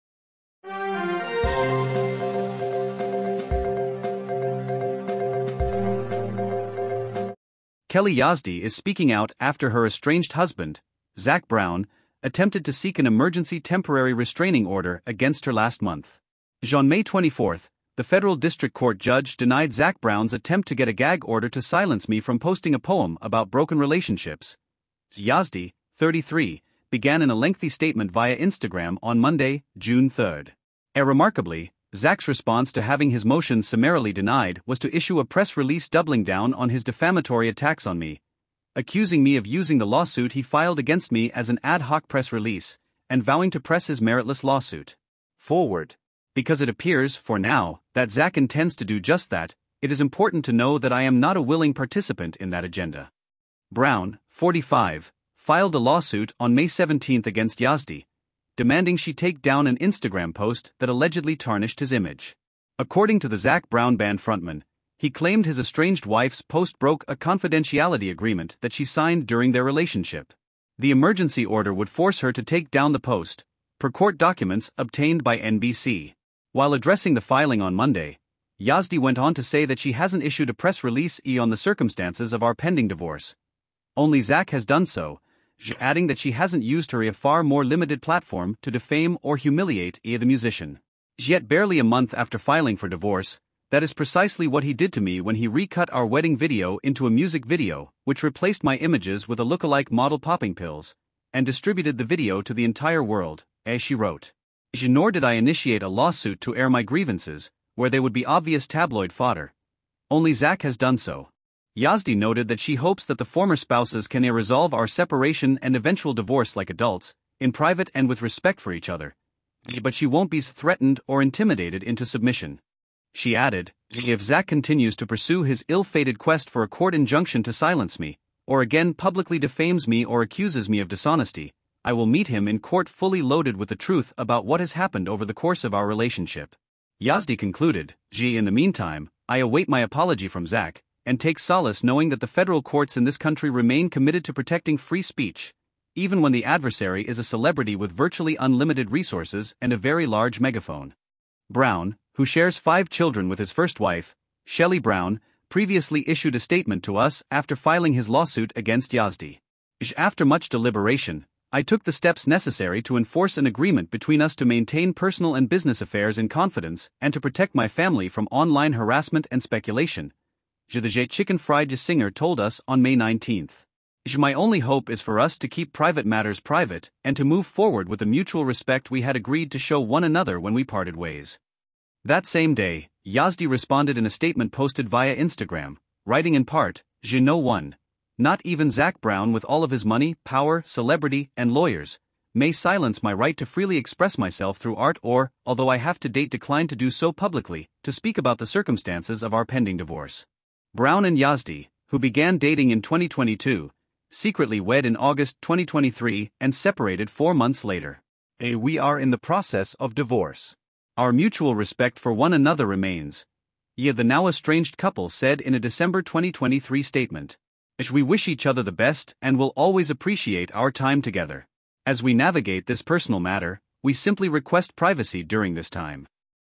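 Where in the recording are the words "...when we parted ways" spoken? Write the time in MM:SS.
03:00.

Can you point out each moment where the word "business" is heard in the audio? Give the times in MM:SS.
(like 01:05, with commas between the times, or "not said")
02:45.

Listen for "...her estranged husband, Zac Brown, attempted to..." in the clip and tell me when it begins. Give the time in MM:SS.
00:09.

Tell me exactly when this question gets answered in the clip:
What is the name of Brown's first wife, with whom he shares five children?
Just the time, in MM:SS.
02:34.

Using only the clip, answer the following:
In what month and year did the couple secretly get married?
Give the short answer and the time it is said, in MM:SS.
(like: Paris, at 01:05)
August 2023, at 03:24.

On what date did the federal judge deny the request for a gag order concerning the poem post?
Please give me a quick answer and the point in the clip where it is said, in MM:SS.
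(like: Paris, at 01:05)
May 24, at 00:16.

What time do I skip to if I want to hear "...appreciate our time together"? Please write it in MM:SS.
03:39.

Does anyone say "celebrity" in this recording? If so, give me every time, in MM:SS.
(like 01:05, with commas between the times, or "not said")
02:27, 03:10.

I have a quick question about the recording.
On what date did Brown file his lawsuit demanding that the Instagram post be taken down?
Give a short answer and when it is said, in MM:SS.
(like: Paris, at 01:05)
May 17, at 00:56.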